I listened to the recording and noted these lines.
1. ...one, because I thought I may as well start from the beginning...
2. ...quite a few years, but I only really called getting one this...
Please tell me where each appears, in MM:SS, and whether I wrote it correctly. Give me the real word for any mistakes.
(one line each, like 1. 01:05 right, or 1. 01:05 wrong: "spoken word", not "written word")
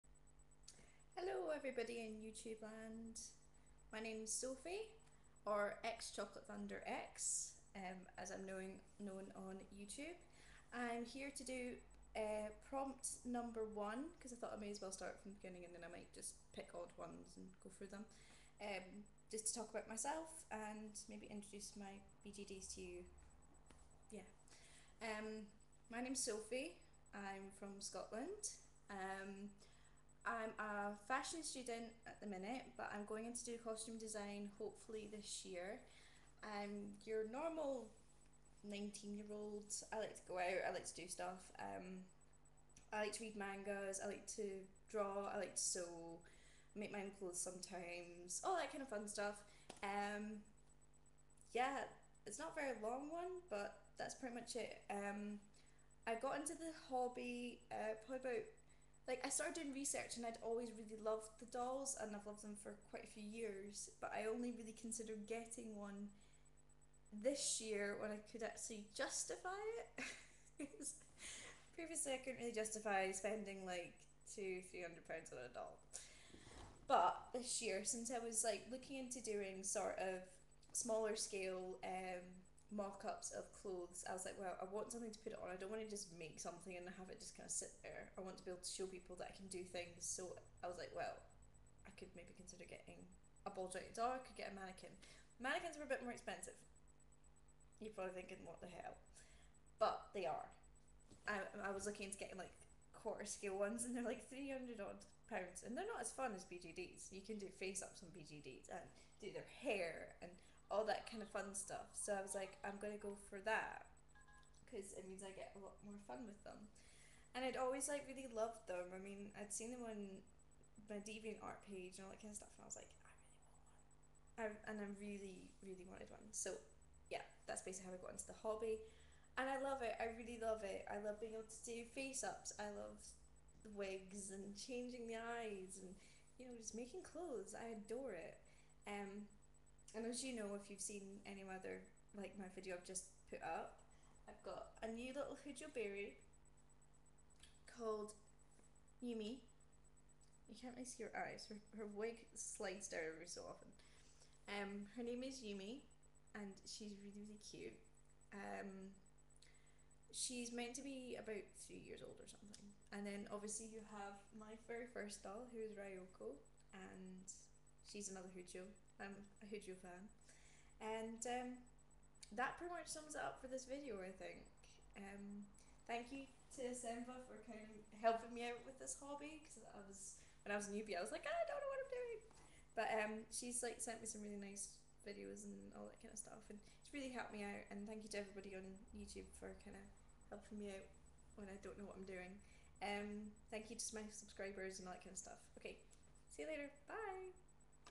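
1. 00:13 right
2. 01:02 wrong: "considered", not "called".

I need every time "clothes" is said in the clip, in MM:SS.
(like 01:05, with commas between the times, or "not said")
00:47, 01:23, 02:17.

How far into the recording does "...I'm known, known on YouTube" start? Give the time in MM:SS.
00:08.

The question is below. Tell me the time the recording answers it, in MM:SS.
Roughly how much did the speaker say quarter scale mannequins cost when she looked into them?
01:44.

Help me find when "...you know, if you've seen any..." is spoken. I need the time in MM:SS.
02:20.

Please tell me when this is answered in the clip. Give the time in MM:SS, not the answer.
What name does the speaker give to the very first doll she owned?
02:45.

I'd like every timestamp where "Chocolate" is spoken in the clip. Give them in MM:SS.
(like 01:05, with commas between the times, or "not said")
00:06.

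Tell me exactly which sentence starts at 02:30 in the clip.
You can't really see her eyes.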